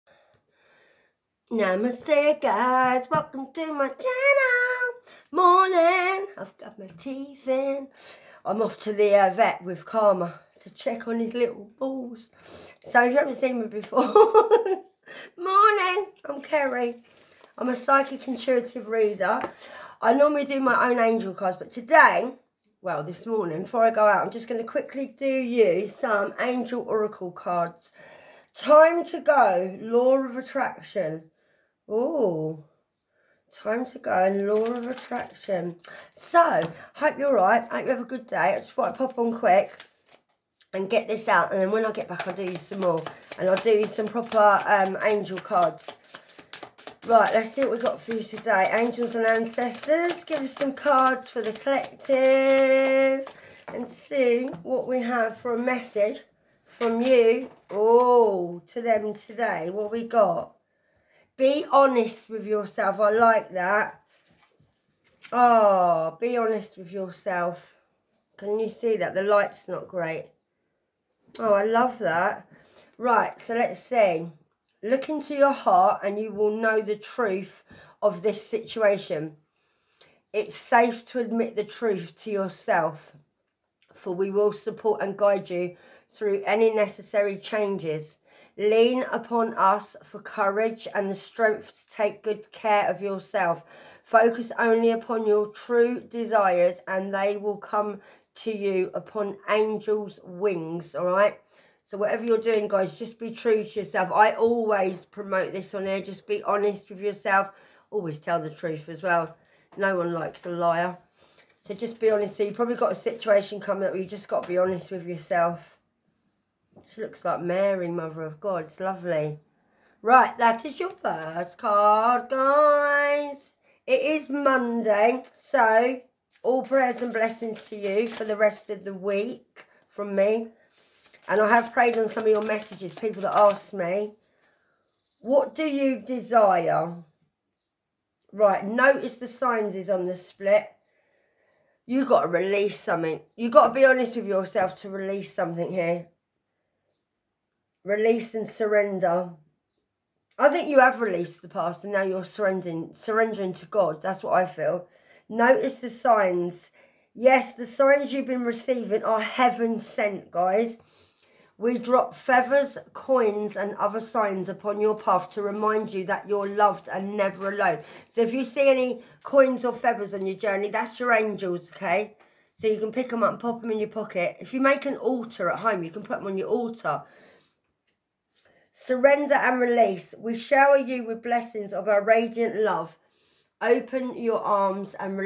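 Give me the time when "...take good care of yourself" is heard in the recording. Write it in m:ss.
1:31.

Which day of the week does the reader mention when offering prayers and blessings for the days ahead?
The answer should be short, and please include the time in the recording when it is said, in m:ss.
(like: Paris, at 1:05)
Monday, at 2:04.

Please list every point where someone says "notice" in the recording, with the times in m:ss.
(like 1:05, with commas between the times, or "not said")
2:18, 2:35.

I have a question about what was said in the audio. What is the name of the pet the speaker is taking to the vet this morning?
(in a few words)
Karma.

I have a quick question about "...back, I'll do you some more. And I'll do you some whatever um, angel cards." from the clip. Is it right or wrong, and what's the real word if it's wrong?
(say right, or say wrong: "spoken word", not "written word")
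wrong: "proper", not "whatever".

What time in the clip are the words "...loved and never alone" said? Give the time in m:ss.
2:46.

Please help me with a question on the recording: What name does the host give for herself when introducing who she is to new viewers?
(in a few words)
Kerry.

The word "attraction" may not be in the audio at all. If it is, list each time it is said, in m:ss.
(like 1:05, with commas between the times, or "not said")
0:30, 0:34.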